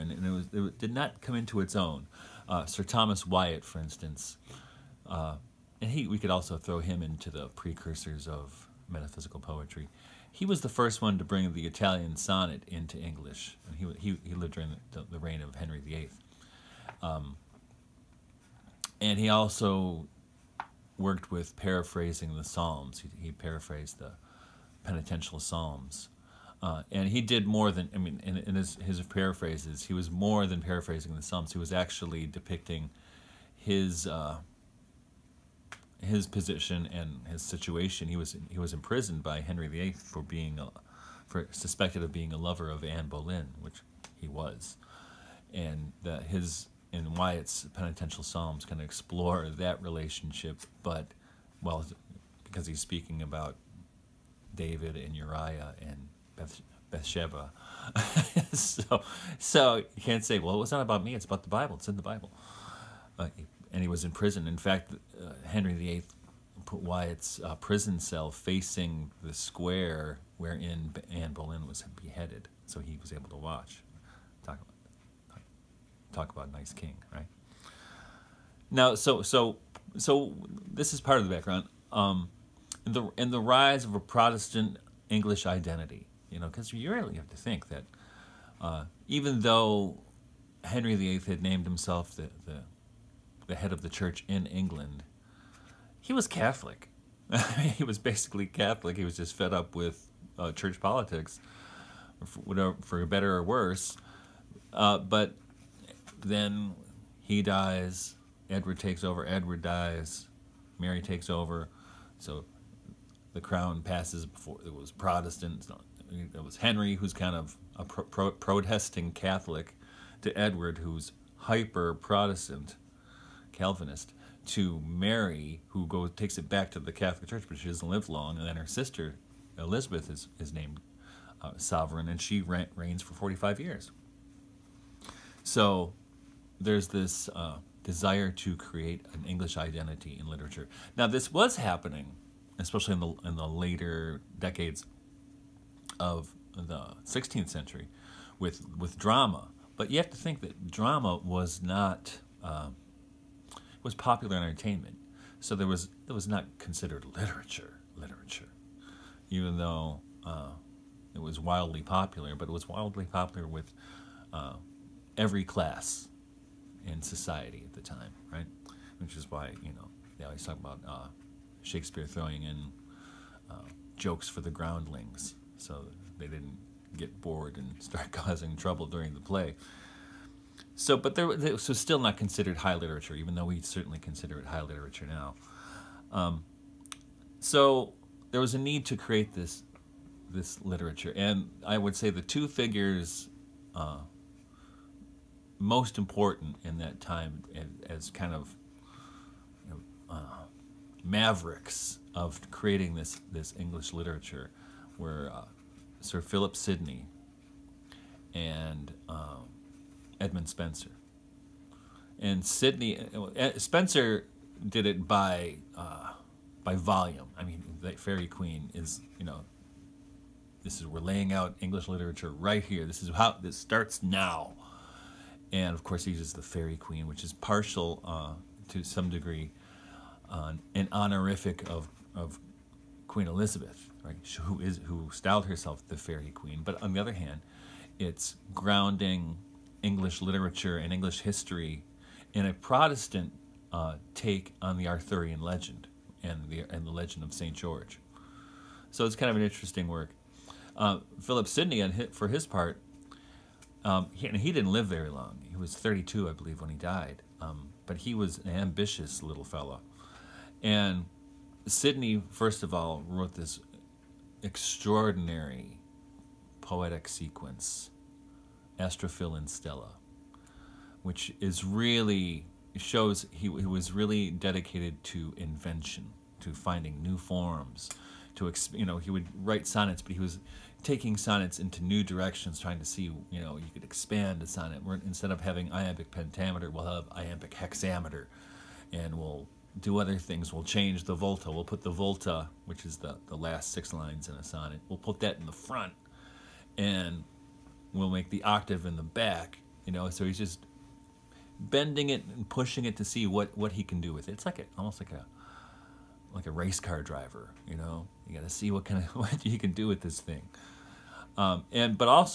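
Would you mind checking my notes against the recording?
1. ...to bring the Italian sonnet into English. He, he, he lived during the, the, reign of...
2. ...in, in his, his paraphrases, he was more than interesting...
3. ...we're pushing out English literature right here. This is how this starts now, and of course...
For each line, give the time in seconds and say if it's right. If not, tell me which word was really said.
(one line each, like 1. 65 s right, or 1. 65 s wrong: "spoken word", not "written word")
1. 11 s right
2. 28 s wrong: "paraphrasing", not "interesting"
3. 220 s wrong: "laying", not "pushing".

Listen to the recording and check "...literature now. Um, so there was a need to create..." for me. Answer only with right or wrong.
right.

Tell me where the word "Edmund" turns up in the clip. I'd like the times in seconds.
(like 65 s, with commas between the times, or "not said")
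210 s.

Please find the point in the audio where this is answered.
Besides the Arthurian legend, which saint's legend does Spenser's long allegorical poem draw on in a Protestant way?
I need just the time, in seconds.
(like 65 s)
247 s.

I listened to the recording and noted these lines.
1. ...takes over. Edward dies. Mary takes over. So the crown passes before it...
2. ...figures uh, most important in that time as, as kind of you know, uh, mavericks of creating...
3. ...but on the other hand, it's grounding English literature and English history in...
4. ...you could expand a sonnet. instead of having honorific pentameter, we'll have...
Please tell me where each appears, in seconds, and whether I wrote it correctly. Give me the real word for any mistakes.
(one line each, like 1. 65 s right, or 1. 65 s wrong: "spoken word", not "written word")
1. 108 s right
2. 192 s right
3. 236 s right
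4. 283 s wrong: "iambic", not "honorific".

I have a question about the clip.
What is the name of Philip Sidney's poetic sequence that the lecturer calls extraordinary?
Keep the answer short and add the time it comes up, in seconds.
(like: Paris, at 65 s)
Astrophil and Stella, at 268 s.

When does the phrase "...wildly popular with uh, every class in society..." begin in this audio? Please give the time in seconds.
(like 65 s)
162 s.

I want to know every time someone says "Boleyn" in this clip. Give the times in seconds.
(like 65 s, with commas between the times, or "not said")
43 s, 71 s.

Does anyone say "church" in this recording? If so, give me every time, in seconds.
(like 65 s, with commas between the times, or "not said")
93 s, 100 s, 127 s.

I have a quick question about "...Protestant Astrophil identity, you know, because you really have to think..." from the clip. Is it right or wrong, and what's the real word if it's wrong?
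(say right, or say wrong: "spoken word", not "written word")
wrong: "English", not "Astrophil".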